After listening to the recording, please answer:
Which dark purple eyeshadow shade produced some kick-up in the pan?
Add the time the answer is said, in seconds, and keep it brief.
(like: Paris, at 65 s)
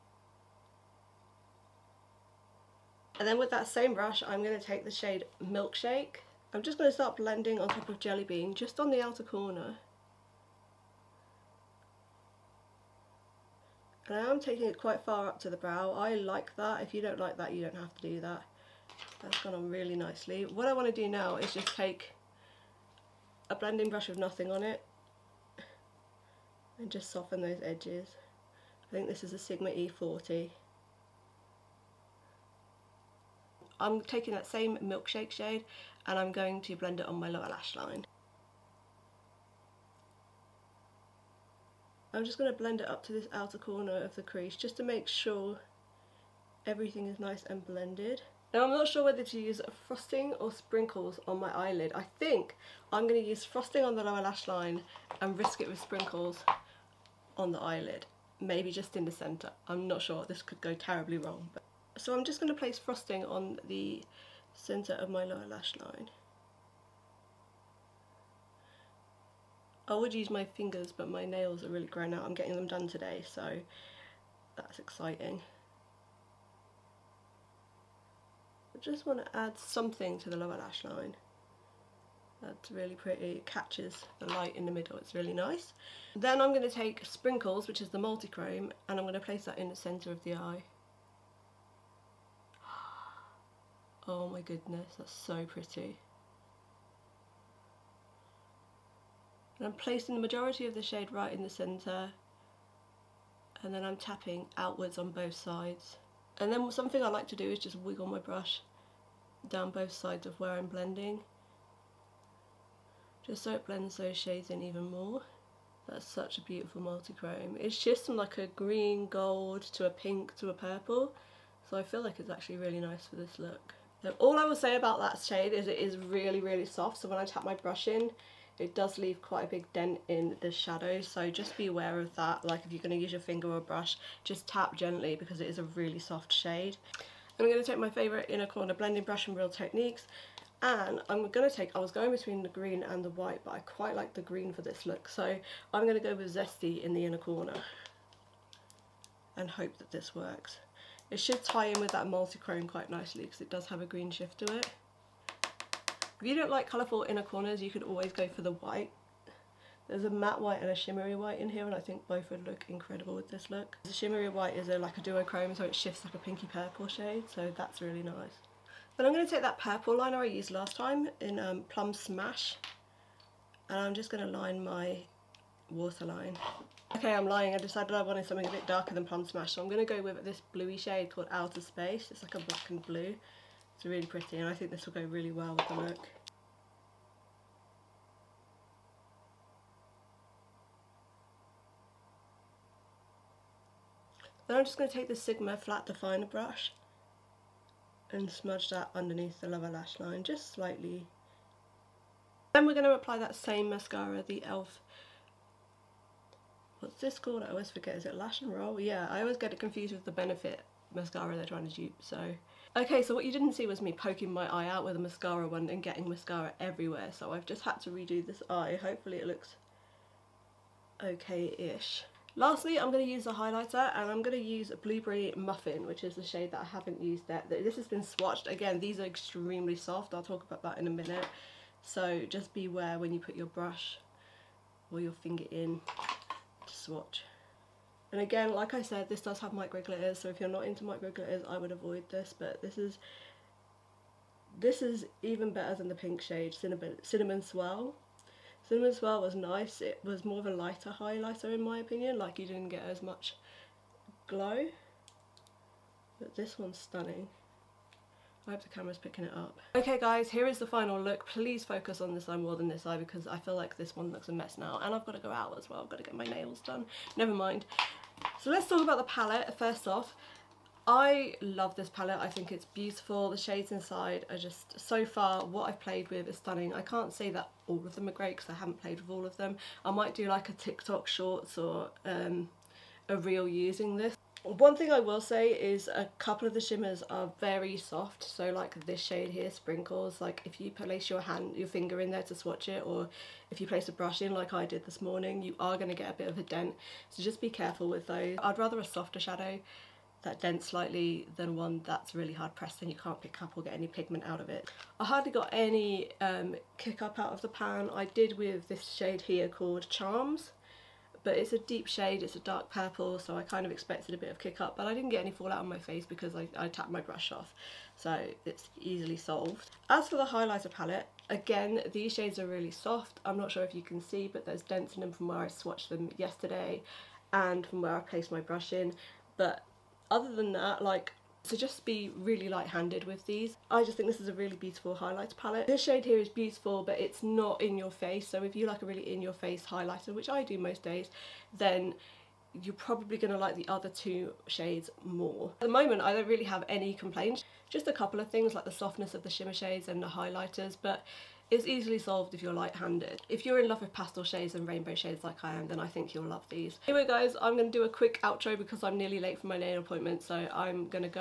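Charms, at 309 s.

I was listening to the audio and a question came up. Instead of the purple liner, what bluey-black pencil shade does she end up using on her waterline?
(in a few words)
Outer Space.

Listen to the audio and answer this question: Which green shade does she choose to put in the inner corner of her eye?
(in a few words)
Zesty.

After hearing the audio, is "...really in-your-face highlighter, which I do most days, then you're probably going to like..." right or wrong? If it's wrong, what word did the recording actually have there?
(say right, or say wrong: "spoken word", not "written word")
right.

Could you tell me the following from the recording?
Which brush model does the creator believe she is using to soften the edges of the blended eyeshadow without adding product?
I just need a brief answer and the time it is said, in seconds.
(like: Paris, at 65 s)
Sigma E40, at 29 s.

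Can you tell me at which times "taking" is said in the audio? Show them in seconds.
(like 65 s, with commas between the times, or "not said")
14 s, 34 s.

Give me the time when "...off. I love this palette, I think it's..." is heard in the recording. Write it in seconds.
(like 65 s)
269 s.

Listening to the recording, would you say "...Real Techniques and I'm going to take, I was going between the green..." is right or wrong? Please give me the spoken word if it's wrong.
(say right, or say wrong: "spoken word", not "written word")
right.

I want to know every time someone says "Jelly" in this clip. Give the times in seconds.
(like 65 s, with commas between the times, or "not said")
7 s.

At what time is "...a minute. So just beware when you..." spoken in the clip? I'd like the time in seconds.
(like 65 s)
230 s.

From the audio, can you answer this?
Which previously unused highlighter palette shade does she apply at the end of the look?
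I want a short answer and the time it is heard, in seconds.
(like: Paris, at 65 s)
Blueberry Muffin, at 224 s.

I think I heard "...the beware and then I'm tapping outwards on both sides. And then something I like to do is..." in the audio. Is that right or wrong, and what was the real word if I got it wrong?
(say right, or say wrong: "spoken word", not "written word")
wrong: "centre", not "beware".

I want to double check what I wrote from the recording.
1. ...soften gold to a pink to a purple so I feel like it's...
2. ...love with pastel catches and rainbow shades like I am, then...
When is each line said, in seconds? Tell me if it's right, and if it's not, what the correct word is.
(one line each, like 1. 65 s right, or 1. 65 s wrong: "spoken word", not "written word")
1. 118 s wrong: "green", not "soften"
2. 353 s wrong: "shades", not "catches".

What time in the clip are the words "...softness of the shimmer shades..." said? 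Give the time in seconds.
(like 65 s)
348 s.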